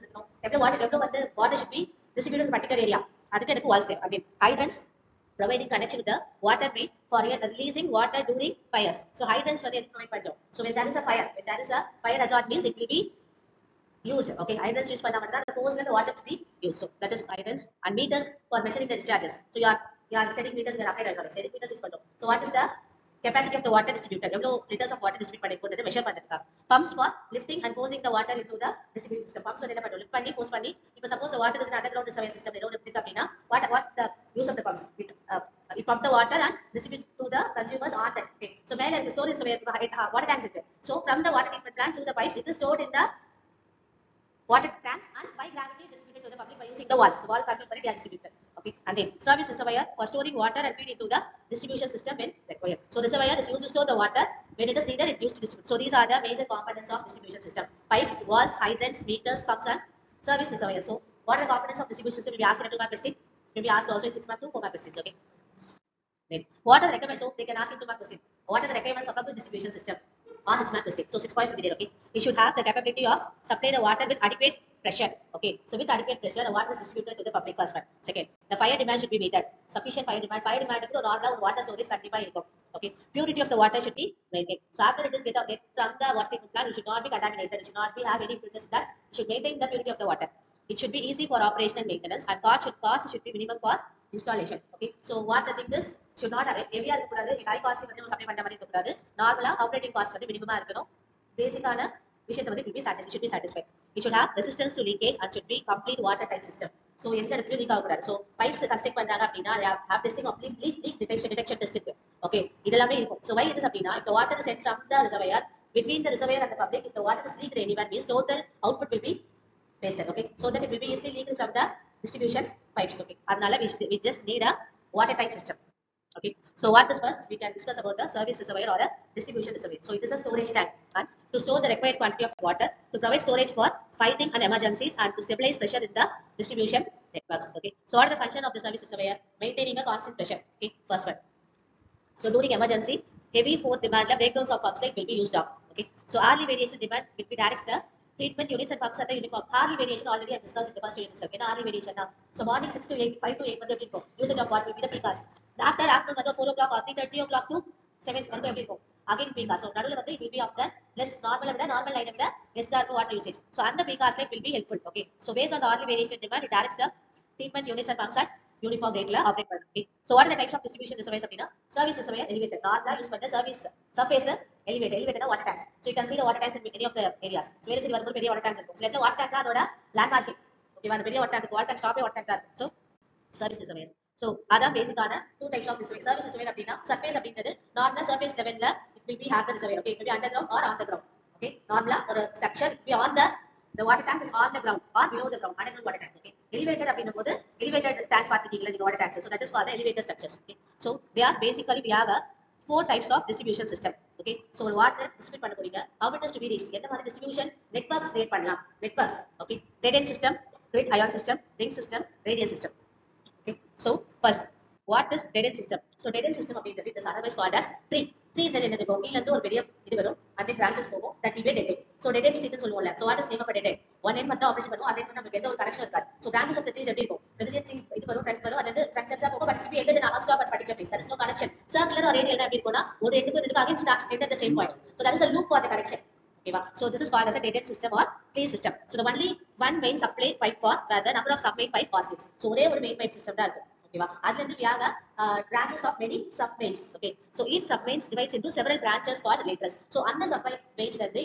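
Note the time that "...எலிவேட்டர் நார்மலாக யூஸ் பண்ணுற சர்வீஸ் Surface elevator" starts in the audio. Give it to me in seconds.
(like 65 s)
172 s.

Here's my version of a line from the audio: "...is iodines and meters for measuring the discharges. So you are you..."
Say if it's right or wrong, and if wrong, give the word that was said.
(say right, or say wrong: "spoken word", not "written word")
right.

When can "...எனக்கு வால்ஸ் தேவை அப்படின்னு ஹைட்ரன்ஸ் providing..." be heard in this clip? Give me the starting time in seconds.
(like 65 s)
3 s.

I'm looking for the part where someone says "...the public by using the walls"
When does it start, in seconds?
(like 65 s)
46 s.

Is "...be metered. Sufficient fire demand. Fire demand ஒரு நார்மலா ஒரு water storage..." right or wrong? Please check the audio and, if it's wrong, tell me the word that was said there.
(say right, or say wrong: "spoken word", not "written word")
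right.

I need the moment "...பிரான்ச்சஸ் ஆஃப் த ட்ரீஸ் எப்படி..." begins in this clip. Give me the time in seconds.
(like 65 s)
226 s.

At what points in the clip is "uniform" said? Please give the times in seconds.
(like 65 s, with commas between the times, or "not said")
149 s.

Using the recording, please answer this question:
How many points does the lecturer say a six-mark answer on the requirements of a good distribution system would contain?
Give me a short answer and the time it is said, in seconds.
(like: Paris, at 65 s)
6, at 71 s.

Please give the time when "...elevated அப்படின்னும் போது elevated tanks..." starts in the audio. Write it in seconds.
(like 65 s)
196 s.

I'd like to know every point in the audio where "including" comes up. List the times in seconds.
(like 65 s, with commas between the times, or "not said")
not said.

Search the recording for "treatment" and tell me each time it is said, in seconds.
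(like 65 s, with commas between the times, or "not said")
41 s, 86 s, 148 s.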